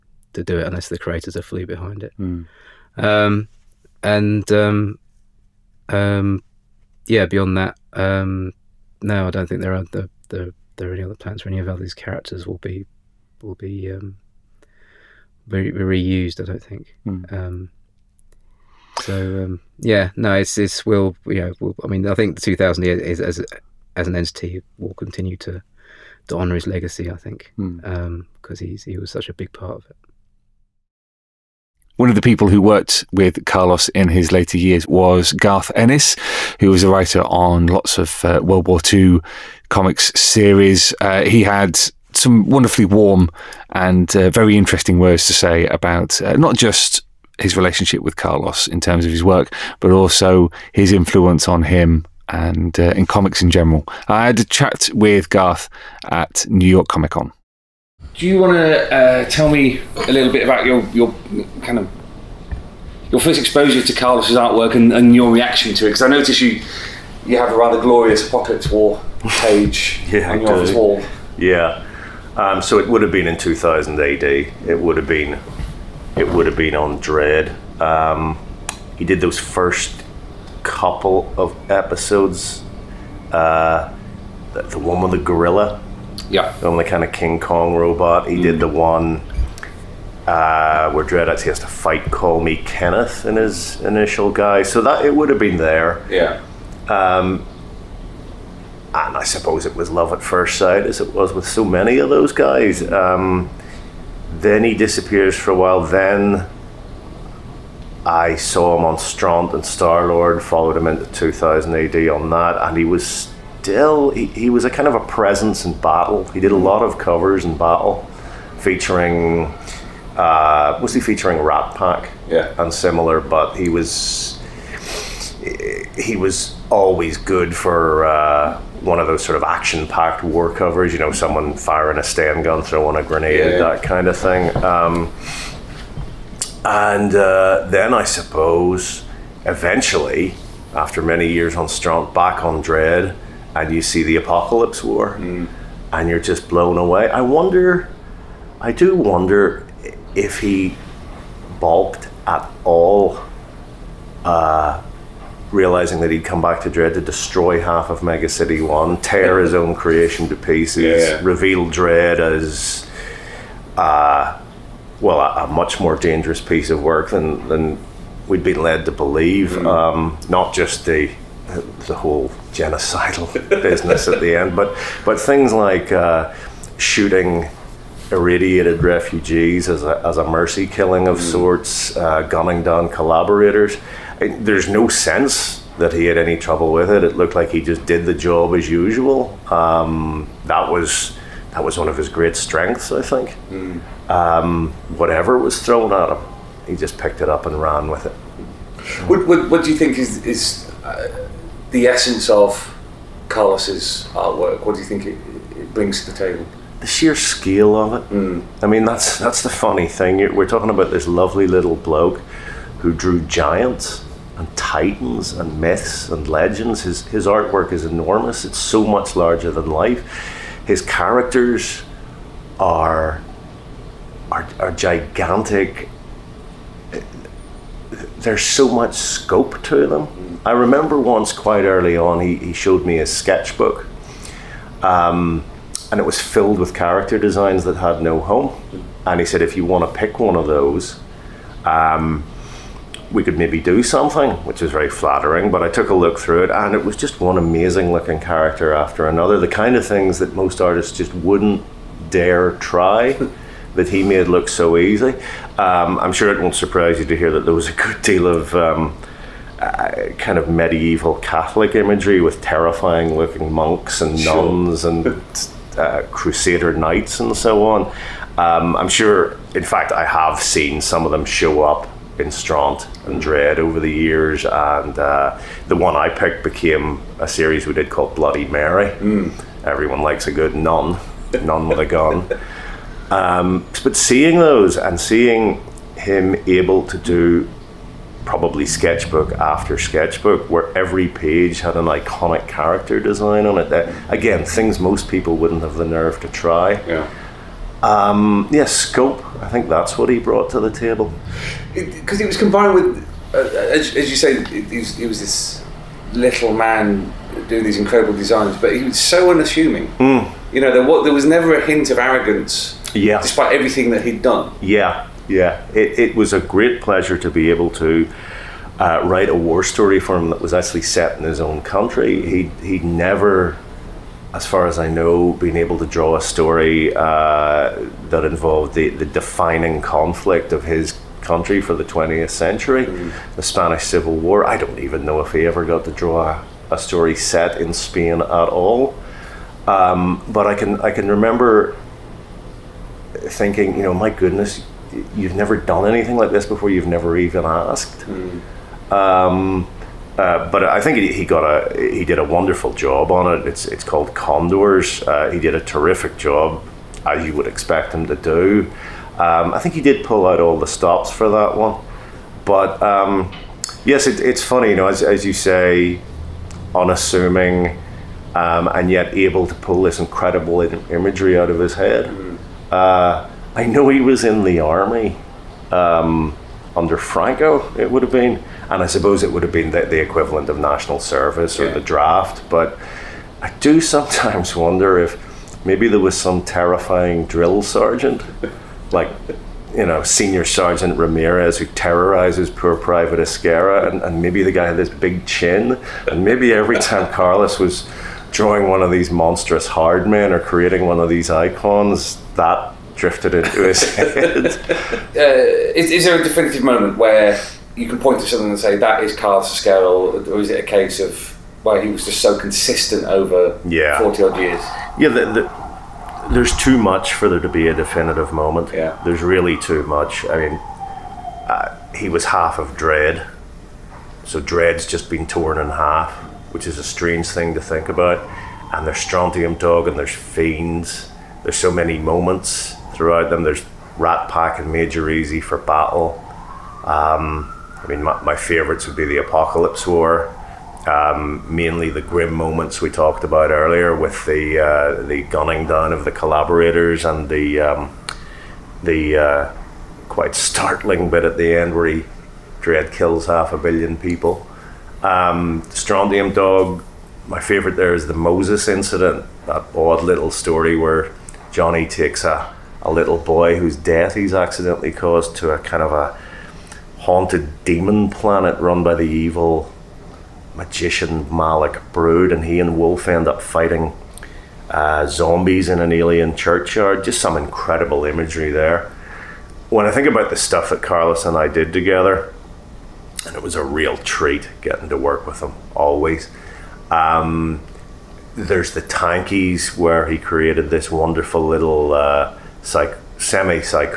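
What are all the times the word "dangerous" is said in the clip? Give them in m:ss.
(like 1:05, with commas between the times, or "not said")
2:45.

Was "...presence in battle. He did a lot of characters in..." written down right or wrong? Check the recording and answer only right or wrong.
wrong.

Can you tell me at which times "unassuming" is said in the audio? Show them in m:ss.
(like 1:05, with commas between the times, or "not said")
5:09, 6:06.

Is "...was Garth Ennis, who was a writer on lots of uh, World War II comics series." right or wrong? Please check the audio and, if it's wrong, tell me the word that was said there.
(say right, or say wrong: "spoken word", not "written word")
right.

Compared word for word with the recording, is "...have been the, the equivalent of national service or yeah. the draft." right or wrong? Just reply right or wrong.
right.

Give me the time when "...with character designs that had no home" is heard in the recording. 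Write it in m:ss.
3:56.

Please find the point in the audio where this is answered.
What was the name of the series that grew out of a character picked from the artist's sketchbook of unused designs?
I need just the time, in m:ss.
4:38.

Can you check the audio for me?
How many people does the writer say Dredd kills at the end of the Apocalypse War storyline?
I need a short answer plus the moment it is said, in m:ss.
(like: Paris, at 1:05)
half a billion, at 7:33.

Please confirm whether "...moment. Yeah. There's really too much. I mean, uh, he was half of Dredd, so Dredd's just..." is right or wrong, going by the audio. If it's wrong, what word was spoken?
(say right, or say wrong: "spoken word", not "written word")
right.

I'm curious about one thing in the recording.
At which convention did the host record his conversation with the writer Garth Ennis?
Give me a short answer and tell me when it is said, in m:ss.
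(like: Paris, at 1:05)
New York Comic Con, at 0:56.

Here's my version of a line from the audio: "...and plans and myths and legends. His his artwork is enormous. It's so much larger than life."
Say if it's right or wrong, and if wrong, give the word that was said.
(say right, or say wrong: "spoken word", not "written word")
wrong: "titans", not "plans".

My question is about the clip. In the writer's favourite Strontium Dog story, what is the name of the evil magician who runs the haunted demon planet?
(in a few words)
Malik Brood.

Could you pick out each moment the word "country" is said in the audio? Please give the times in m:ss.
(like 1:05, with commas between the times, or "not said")
5:21, 5:31.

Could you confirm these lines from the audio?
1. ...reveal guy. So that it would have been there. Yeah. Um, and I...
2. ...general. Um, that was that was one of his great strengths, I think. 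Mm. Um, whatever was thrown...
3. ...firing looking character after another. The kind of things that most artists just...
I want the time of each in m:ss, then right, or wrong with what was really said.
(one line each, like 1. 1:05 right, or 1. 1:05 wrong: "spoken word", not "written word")
1. 1:33 wrong: "initial", not "reveal"
2. 3:08 wrong: "usual", not "general"
3. 4:07 wrong: "amazing", not "firing".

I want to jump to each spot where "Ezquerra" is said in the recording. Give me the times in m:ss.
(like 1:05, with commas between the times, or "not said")
6:33, 6:49.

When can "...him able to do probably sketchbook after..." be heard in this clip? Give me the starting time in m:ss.
4:45.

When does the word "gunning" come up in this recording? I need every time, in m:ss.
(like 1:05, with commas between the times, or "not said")
3:02, 7:25.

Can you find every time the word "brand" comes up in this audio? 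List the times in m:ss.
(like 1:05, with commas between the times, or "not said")
not said.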